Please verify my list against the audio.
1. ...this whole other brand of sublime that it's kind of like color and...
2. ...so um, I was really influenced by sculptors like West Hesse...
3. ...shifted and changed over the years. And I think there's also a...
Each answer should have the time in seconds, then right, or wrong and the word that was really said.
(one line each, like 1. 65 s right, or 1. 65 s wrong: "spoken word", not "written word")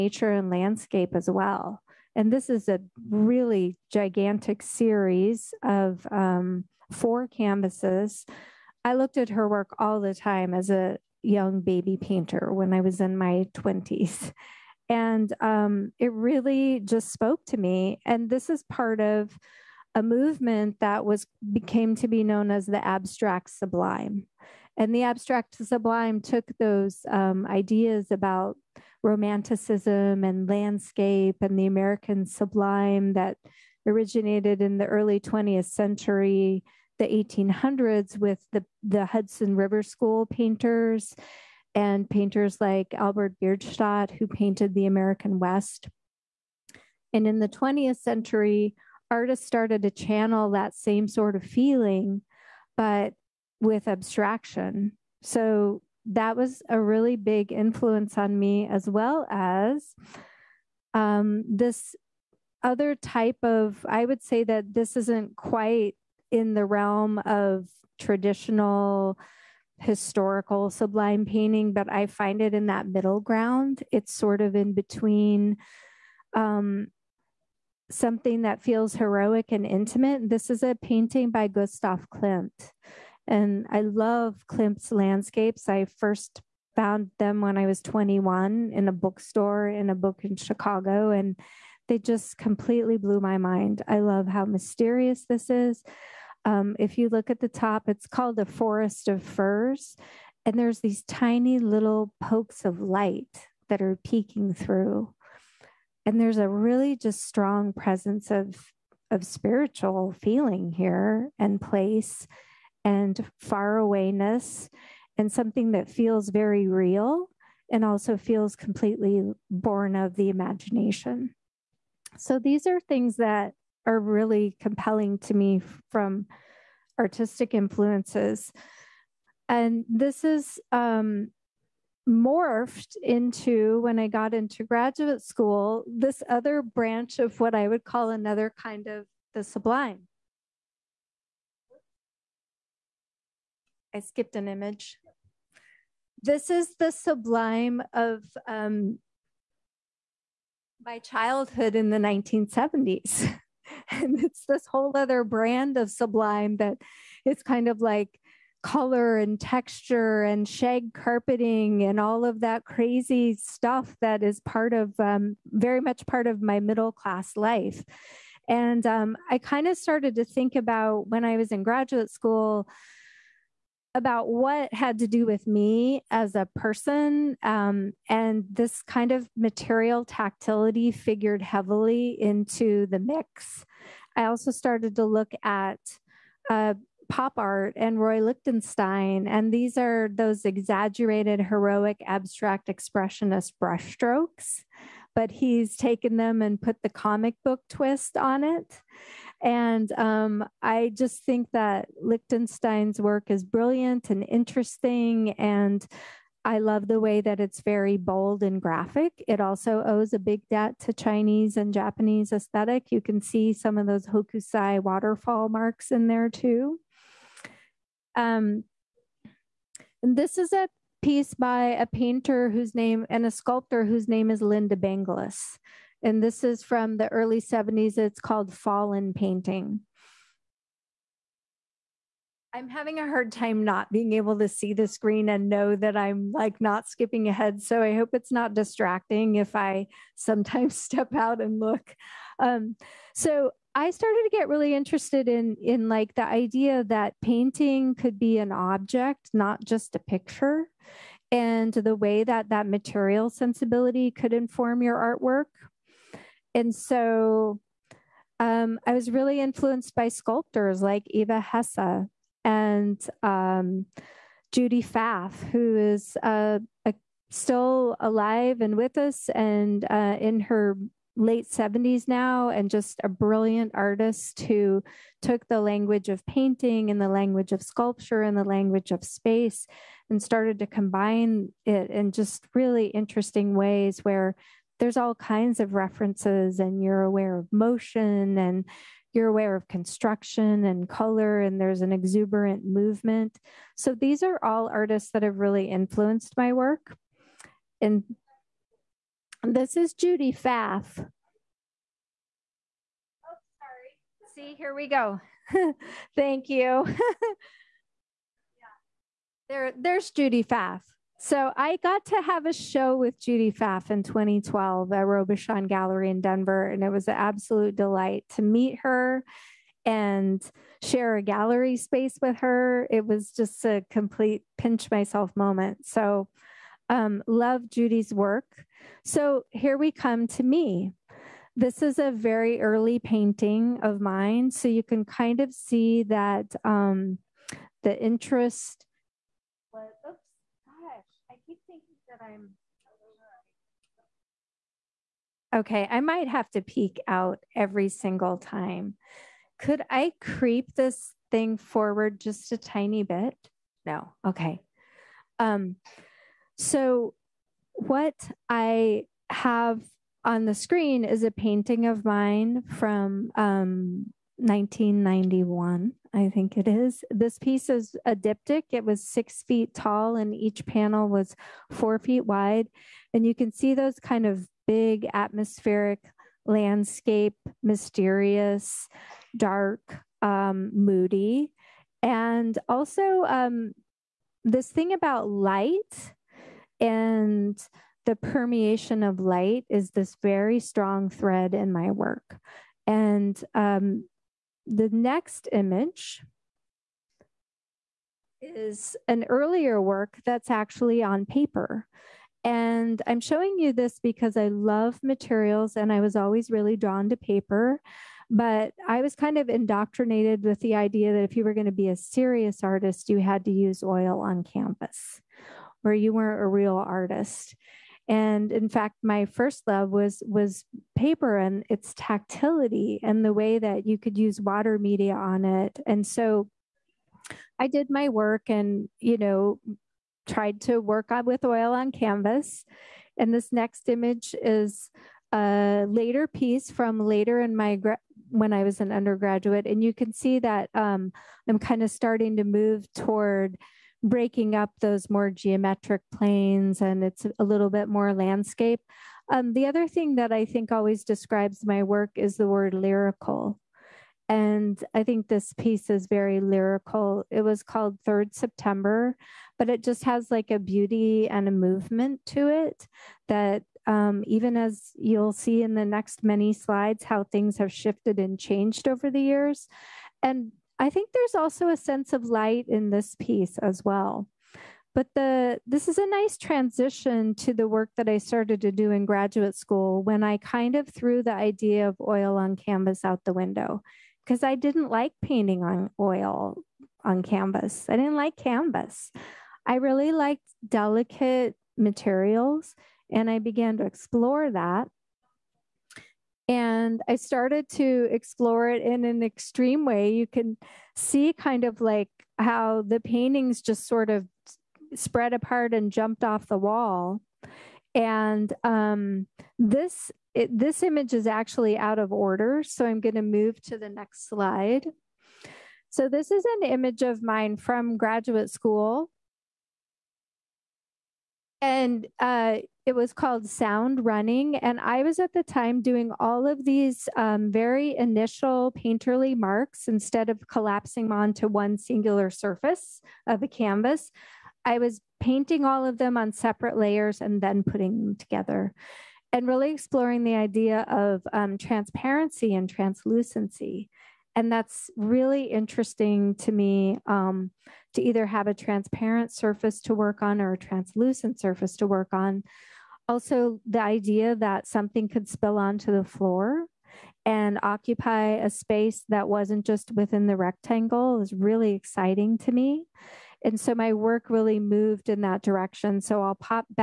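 1. 154 s right
2. 256 s wrong: "Eva", not "West"
3. 467 s right.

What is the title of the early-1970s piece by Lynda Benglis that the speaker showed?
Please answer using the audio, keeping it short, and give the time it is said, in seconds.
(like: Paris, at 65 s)
Fallen Painting, at 228 s.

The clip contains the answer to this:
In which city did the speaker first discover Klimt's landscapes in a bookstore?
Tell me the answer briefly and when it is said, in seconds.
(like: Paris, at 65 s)
Chicago, at 90 s.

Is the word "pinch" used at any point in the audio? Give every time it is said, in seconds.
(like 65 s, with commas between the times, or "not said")
324 s.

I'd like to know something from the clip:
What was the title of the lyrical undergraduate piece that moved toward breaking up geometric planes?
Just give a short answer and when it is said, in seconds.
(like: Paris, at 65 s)
Third September, at 458 s.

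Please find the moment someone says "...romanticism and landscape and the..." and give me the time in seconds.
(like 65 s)
29 s.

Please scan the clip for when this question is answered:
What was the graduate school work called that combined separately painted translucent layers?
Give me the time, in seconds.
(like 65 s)
523 s.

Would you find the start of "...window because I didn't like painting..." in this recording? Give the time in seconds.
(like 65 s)
483 s.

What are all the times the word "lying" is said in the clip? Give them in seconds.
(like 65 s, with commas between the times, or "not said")
not said.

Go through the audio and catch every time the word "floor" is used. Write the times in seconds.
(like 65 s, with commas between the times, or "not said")
556 s.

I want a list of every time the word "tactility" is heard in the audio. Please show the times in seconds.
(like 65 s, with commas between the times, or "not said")
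180 s, 421 s.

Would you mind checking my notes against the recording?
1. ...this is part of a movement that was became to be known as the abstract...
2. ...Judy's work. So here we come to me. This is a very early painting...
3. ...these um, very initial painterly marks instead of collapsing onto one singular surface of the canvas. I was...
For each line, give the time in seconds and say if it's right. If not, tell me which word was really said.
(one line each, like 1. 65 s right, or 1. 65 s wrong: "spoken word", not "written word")
1. 18 s right
2. 327 s right
3. 526 s right.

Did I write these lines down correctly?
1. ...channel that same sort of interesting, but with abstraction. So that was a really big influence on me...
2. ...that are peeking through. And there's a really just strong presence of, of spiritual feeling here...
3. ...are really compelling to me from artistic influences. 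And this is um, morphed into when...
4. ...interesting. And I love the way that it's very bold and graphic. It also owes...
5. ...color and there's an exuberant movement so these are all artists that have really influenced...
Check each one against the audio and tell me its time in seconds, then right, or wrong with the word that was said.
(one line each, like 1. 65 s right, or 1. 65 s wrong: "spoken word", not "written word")
1. 49 s wrong: "feeling", not "interesting"
2. 103 s right
3. 123 s right
4. 204 s right
5. 290 s right.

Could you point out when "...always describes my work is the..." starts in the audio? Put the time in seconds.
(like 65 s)
450 s.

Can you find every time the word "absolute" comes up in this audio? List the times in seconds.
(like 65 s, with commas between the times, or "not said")
317 s.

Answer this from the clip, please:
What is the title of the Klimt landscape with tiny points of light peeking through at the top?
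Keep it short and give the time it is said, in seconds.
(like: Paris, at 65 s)
The Forest of Firs, at 98 s.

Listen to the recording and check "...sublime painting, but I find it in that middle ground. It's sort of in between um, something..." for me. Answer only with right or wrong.
right.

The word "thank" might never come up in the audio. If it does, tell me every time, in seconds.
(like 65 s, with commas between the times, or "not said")
306 s.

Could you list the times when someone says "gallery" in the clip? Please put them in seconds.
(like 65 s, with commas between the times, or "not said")
315 s, 321 s.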